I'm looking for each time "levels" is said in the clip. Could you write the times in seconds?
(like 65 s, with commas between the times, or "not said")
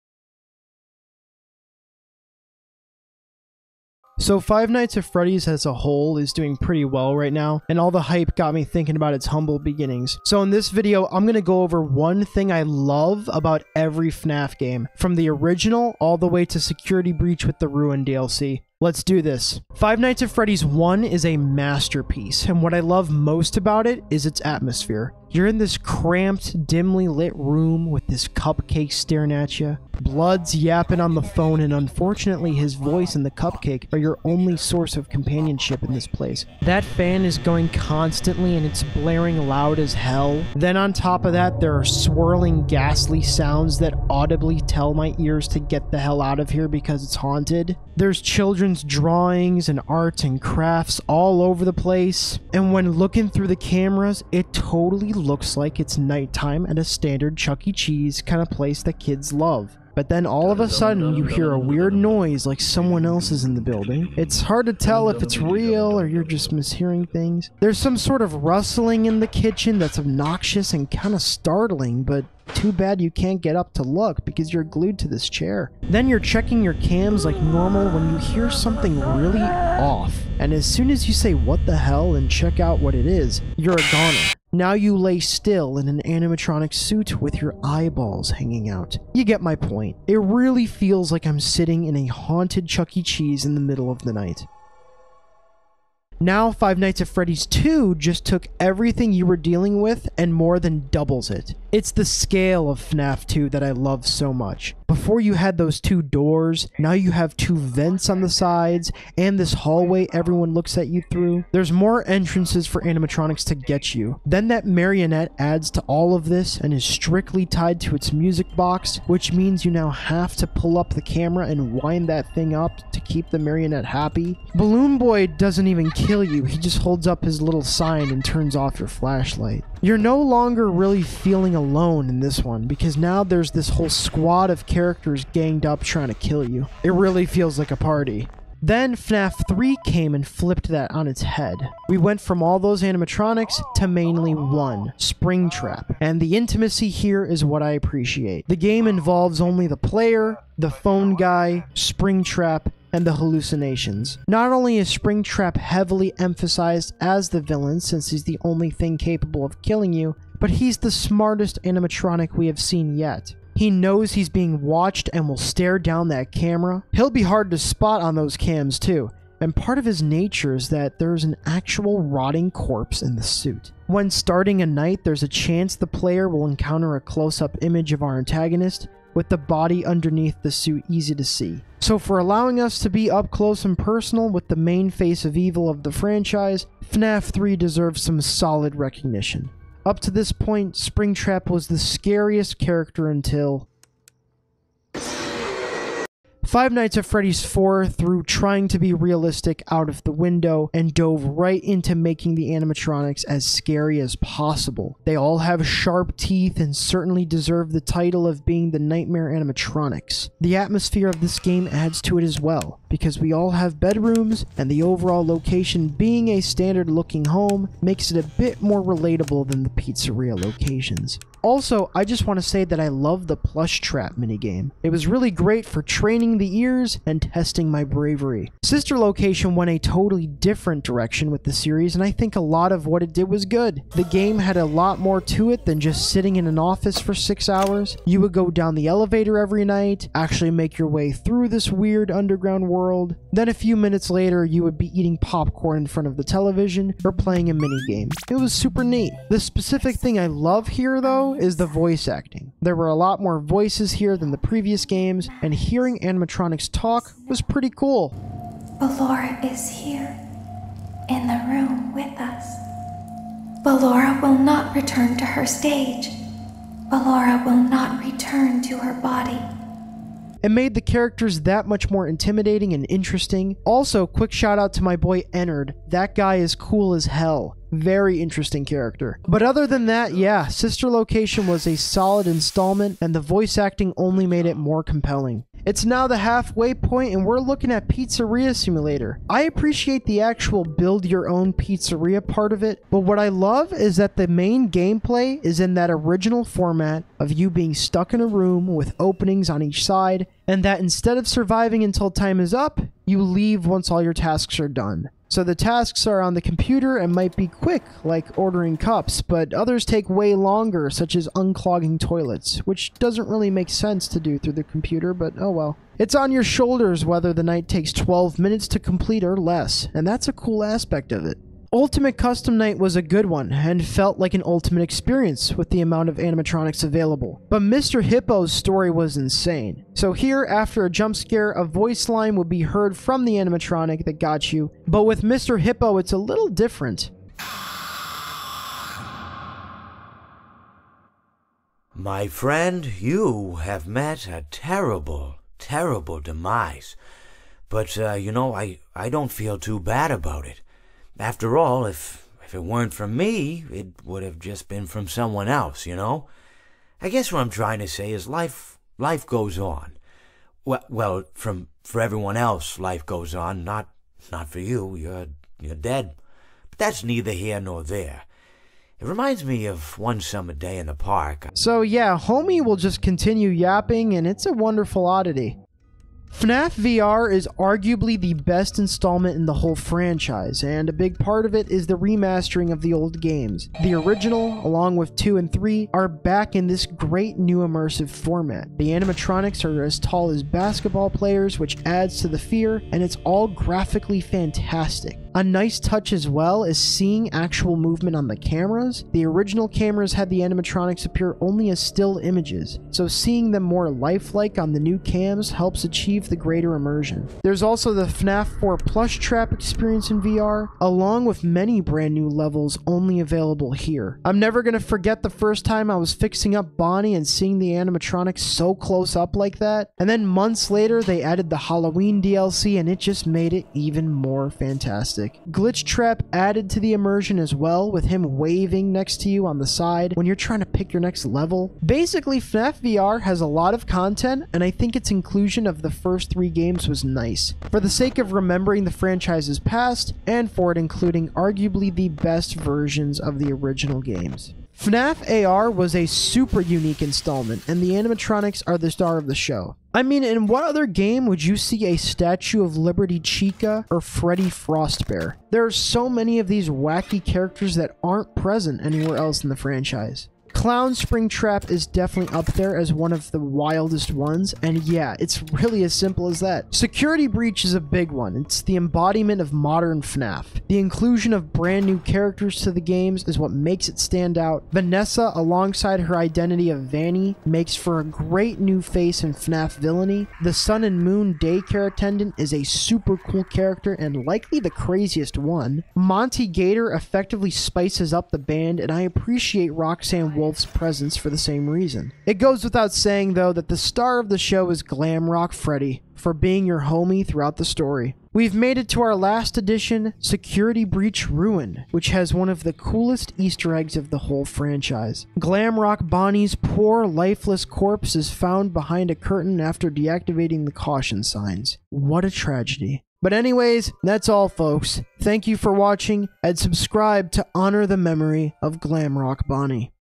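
412 s, 431 s.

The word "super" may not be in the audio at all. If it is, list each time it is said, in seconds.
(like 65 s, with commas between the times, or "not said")
248 s, 446 s, 482 s.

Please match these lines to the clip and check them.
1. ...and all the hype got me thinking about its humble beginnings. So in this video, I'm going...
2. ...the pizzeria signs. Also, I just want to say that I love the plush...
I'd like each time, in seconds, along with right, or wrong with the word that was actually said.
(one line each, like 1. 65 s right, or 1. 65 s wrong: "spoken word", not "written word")
1. 7 s right
2. 219 s wrong: "locations", not "signs".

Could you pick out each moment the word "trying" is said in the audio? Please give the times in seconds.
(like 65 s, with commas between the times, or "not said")
135 s, 198 s, 357 s, 430 s.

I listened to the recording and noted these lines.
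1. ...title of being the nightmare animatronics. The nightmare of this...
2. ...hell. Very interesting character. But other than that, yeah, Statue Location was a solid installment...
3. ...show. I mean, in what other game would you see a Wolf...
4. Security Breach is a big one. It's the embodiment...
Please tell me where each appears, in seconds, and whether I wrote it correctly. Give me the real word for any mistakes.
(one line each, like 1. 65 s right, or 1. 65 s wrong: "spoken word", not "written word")
1. 207 s wrong: "atmosphere", not "nightmare"
2. 277 s wrong: "Sister", not "Statue"
3. 449 s wrong: "Statue", not "Wolf"
4. 466 s right.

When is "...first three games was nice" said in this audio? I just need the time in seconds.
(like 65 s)
435 s.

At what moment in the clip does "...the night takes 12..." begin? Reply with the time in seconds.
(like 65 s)
317 s.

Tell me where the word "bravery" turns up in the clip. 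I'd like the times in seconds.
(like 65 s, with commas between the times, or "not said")
227 s.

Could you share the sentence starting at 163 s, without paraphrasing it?
He knows he's being watched and will stare down that camera.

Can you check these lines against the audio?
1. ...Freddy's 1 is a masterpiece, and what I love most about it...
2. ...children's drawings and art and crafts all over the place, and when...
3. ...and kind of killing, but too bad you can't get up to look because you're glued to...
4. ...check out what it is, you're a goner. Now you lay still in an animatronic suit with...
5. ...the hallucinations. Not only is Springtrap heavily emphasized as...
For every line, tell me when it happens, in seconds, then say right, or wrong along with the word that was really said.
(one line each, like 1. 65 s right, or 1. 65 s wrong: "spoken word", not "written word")
1. 20 s right
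2. 48 s right
3. 70 s wrong: "startling", not "killing"
4. 82 s right
5. 153 s right.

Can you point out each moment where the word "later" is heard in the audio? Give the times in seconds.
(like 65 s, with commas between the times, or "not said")
244 s, 420 s.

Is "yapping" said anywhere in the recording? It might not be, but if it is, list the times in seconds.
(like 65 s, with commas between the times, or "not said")
30 s, 373 s.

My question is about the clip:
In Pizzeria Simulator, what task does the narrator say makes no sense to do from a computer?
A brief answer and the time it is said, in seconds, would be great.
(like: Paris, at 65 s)
Unclogging toilets, at 311 s.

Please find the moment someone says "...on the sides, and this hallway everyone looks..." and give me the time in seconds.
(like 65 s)
108 s.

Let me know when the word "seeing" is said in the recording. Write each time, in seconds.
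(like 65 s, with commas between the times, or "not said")
396 s, 403 s, 417 s.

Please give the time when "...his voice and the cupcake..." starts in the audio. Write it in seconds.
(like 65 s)
32 s.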